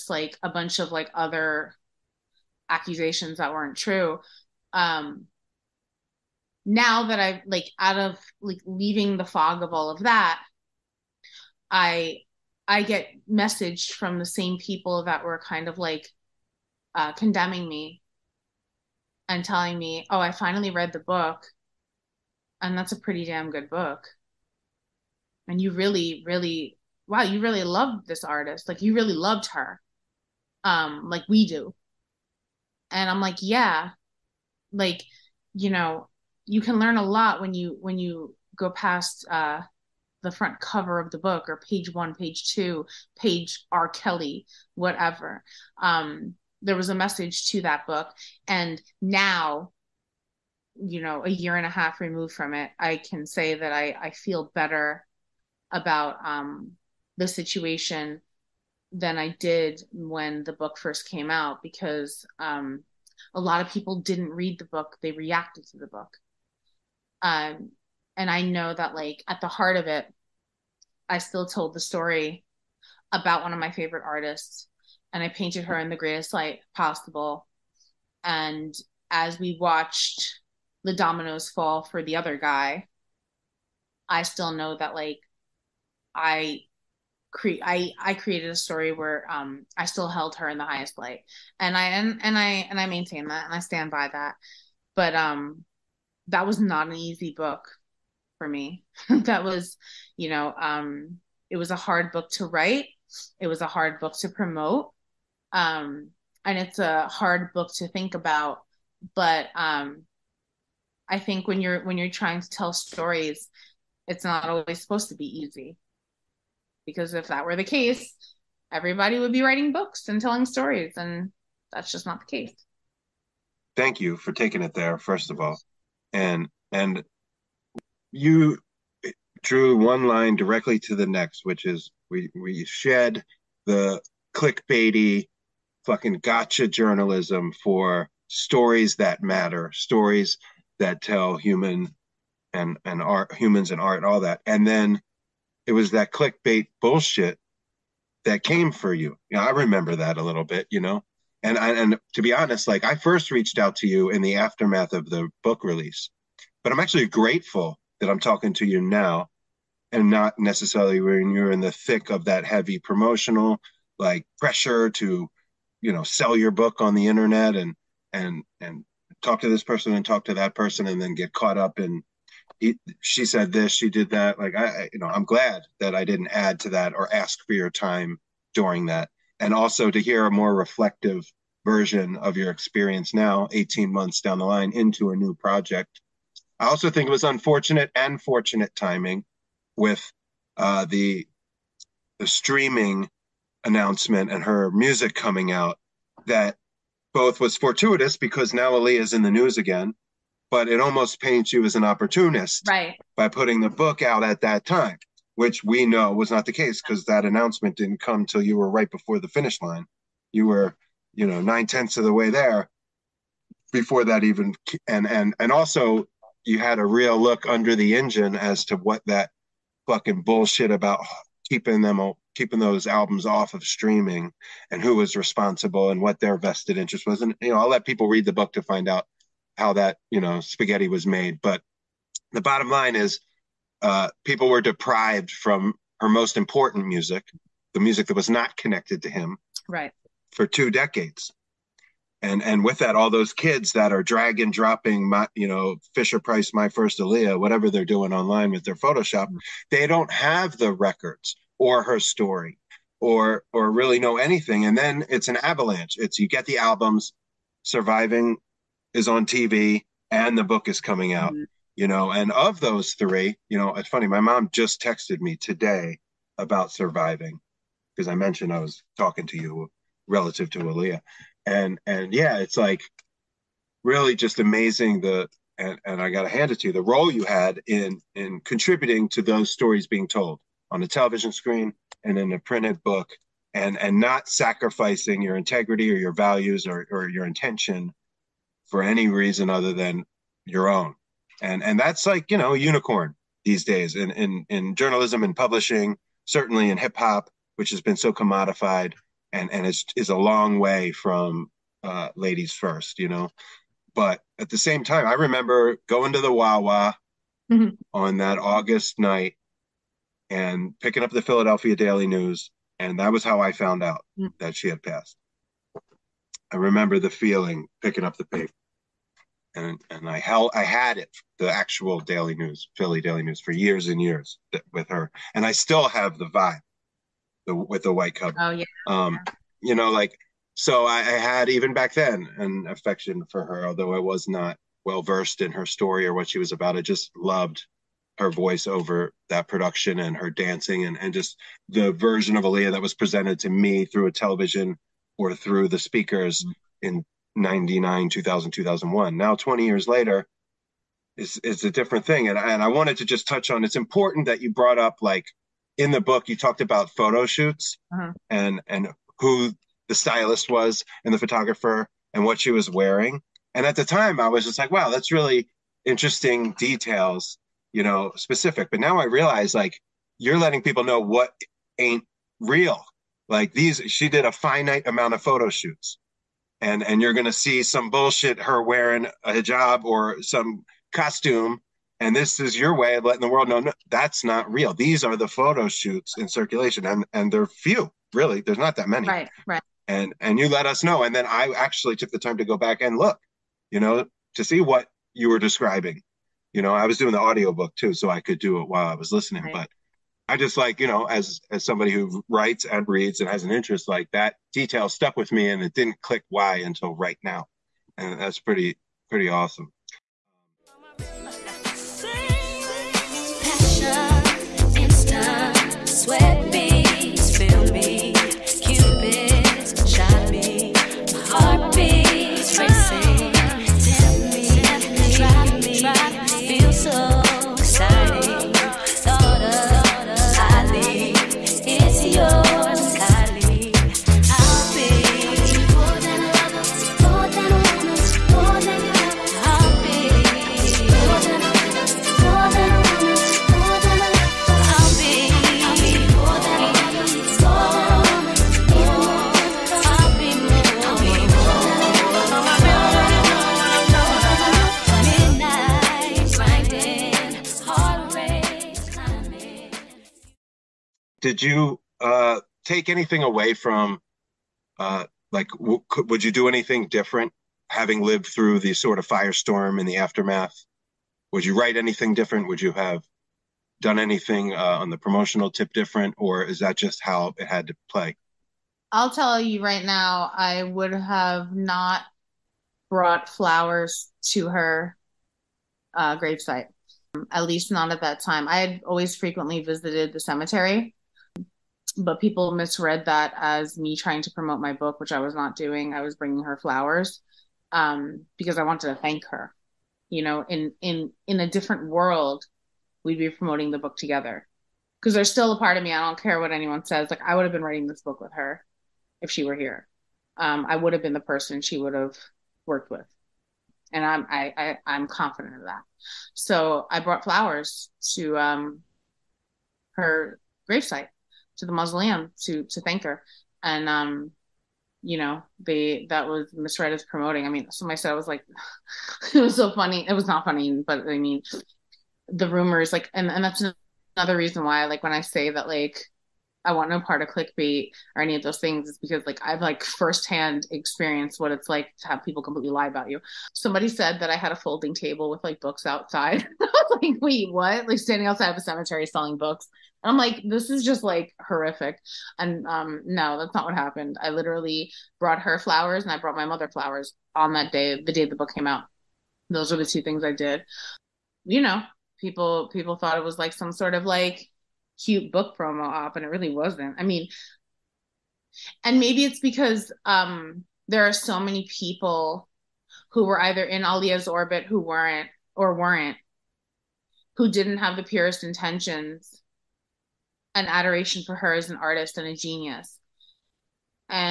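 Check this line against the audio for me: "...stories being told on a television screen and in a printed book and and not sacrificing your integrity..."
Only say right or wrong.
right.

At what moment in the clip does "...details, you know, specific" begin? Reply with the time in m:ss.
6:06.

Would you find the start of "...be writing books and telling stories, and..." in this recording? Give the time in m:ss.
1:59.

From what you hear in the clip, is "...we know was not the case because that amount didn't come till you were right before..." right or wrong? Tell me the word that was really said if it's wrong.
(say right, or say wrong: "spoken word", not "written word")
wrong: "announcement", not "amount".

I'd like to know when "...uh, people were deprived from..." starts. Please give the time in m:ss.
3:53.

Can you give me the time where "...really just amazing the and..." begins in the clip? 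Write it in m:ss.
4:33.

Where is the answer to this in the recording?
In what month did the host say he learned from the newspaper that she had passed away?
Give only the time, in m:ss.
5:08.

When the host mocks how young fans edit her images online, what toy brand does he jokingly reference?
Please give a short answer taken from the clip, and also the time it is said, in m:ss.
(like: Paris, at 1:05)
Fisher Price, at 4:05.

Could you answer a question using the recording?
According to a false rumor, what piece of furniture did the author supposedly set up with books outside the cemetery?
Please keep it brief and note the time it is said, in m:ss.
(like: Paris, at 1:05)
A folding table, at 9:04.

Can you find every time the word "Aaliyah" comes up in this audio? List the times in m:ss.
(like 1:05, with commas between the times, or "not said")
3:18, 4:06, 4:30, 5:42, 9:33.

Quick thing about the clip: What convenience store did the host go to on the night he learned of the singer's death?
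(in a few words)
Wawa.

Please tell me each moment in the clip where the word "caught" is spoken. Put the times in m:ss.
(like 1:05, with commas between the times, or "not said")
2:51.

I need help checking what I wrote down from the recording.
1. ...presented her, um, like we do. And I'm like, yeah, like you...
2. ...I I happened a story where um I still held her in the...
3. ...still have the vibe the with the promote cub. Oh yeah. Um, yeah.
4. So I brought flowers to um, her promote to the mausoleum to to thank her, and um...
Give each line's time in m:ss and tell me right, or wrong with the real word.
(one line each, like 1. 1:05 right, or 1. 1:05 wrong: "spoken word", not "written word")
1. 0:29 wrong: "loved", not "presented"
2. 1:27 wrong: "created", not "happened"
3. 5:25 wrong: "white", not "promote"
4. 8:36 wrong: "gravesite", not "promote".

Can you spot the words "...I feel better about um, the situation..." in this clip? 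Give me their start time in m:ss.
0:53.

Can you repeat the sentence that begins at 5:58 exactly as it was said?
and and who the stylist was and the photographer and what she was wearing.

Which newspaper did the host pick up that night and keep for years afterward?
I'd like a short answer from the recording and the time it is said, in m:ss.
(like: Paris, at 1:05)
Philadelphia Daily News, at 5:11.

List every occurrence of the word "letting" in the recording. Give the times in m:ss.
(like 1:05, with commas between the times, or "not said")
6:10, 6:23.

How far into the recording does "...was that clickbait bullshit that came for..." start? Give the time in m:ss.
2:25.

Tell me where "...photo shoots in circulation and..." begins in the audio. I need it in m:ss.
6:25.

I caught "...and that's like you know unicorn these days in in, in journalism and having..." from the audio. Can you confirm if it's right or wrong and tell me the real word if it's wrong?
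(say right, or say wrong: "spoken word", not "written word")
wrong: "publishing", not "having".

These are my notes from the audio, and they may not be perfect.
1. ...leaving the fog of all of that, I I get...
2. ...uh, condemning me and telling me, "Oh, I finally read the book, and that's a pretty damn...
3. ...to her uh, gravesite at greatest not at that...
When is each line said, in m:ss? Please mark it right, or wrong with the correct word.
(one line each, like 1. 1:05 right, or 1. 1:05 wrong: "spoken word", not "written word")
1. 0:08 right
2. 0:16 right
3. 8:04 wrong: "least", not "greatest".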